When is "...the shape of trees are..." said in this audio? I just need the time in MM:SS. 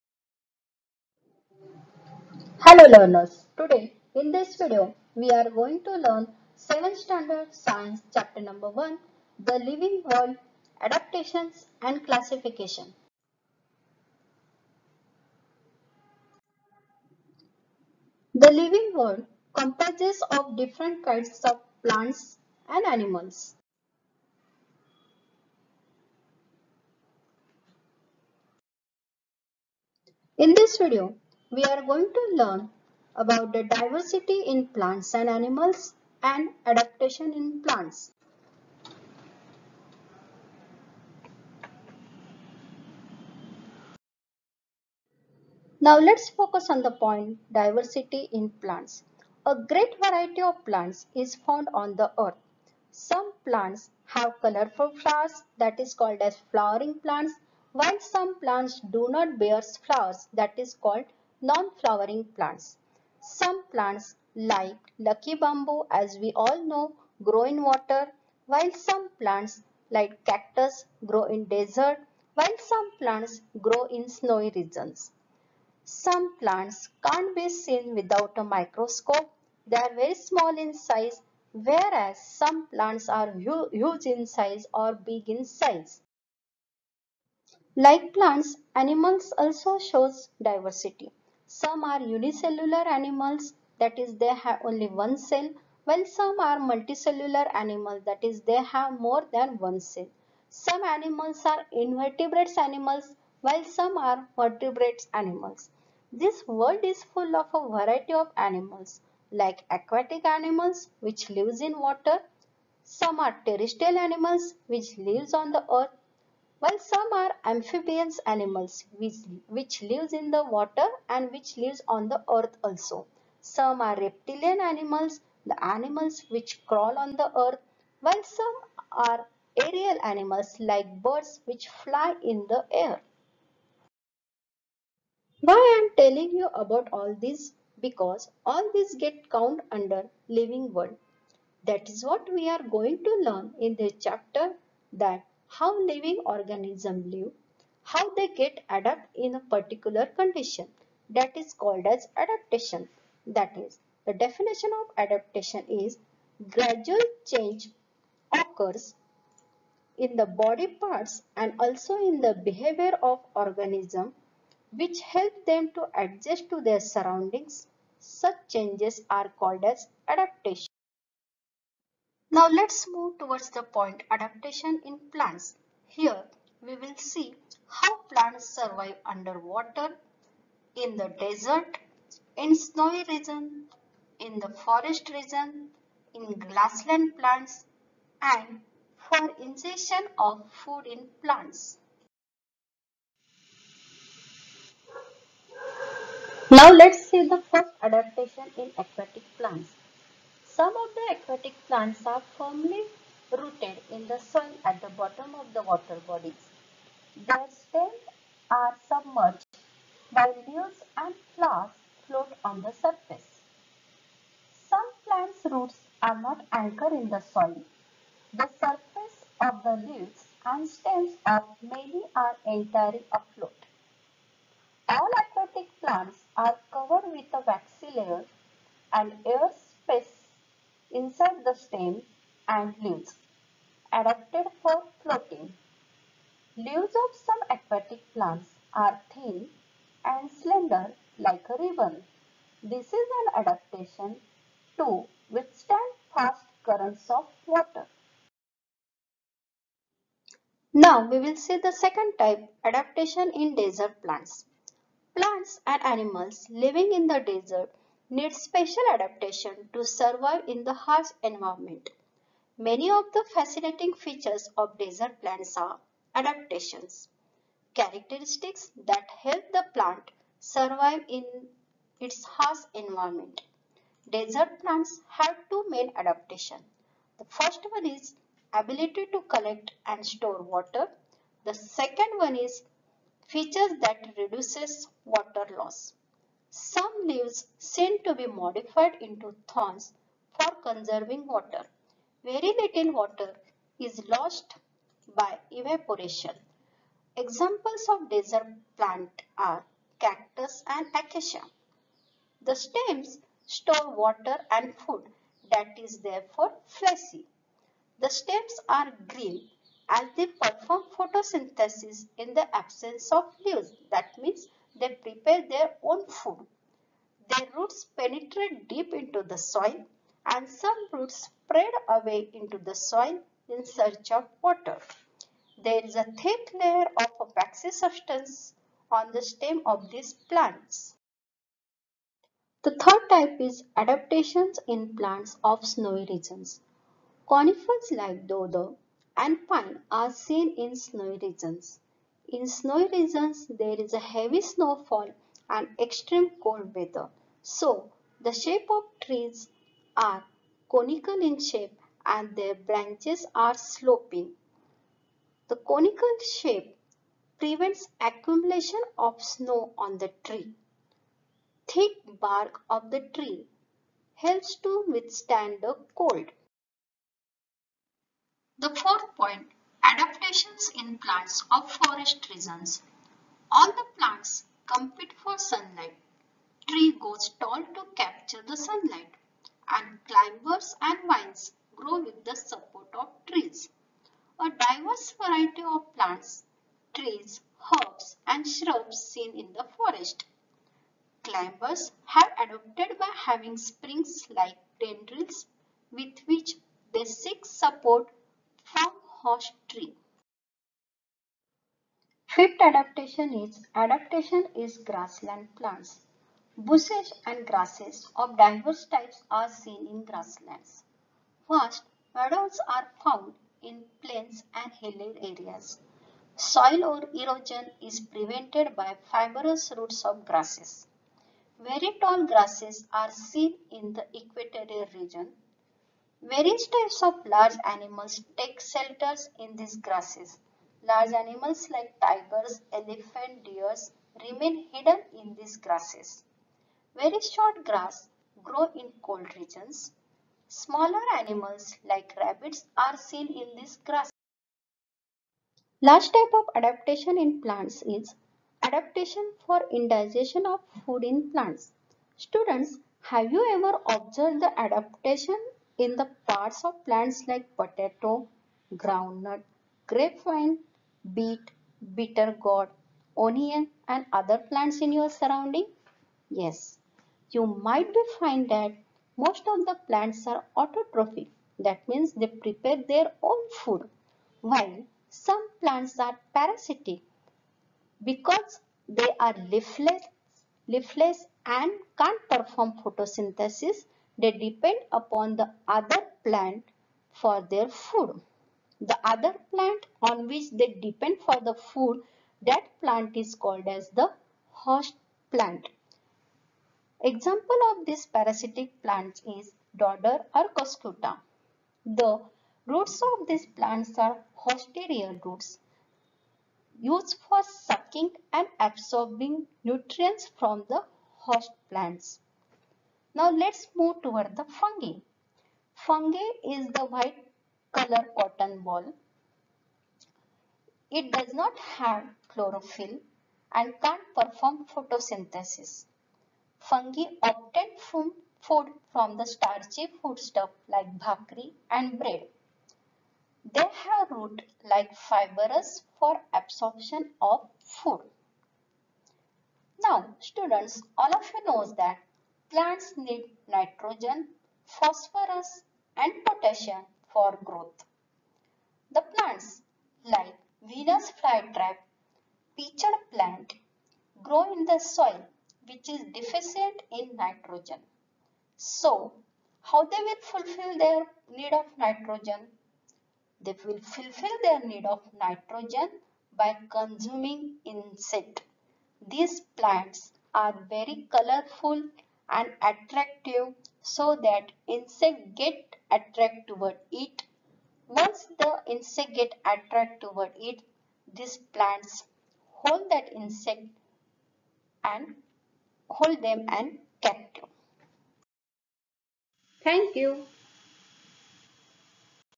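05:48.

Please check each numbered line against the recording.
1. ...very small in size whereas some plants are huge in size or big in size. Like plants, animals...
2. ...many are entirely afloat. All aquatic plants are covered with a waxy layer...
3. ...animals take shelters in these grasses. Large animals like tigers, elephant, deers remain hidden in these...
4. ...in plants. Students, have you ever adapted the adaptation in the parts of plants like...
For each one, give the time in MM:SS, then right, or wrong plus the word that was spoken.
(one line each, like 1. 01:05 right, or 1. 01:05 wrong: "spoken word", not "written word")
1. 01:19 right
2. 03:41 right
3. 07:07 right
4. 07:31 wrong: "observed", not "adapted".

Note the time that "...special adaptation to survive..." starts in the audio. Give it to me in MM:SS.
04:18.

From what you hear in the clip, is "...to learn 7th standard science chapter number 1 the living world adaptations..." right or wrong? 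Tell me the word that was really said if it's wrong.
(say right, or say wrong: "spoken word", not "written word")
right.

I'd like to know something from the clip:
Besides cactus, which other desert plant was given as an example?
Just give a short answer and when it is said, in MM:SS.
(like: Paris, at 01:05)
Acacia, at 05:00.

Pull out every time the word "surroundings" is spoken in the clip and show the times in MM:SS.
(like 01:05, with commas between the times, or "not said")
02:46, 07:45.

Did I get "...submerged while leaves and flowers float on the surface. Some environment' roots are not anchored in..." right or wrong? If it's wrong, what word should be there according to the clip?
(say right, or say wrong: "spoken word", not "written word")
wrong: "plants", not "environment".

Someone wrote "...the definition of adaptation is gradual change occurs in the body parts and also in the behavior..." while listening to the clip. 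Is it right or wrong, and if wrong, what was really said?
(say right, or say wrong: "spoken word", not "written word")
right.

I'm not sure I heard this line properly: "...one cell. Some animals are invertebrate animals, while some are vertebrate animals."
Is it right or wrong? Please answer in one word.
right.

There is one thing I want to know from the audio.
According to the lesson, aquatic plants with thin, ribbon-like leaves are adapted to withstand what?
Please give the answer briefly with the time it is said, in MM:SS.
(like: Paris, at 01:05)
Fast currents of water, at 04:06.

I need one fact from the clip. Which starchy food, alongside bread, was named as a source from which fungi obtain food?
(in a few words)
Bhakri.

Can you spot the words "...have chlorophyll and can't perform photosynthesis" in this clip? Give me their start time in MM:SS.
08:41.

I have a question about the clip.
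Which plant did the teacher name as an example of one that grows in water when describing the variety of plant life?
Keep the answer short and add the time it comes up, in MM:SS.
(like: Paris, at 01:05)
Lucky bamboo, at 01:04.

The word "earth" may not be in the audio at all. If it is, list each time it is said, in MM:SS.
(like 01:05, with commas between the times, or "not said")
00:52, 01:55, 02:02, 02:07.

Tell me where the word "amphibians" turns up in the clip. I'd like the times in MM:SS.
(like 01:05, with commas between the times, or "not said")
01:57.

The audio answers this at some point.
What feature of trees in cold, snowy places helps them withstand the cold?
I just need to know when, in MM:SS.
06:01.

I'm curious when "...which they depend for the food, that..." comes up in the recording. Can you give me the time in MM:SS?
08:10.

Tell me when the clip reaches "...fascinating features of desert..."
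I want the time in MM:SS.
04:23.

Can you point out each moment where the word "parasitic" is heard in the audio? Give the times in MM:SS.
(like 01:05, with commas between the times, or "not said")
07:56, 08:18.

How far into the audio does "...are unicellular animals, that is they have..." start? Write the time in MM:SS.
01:31.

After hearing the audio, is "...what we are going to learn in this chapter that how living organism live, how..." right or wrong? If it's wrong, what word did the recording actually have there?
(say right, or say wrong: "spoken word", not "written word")
right.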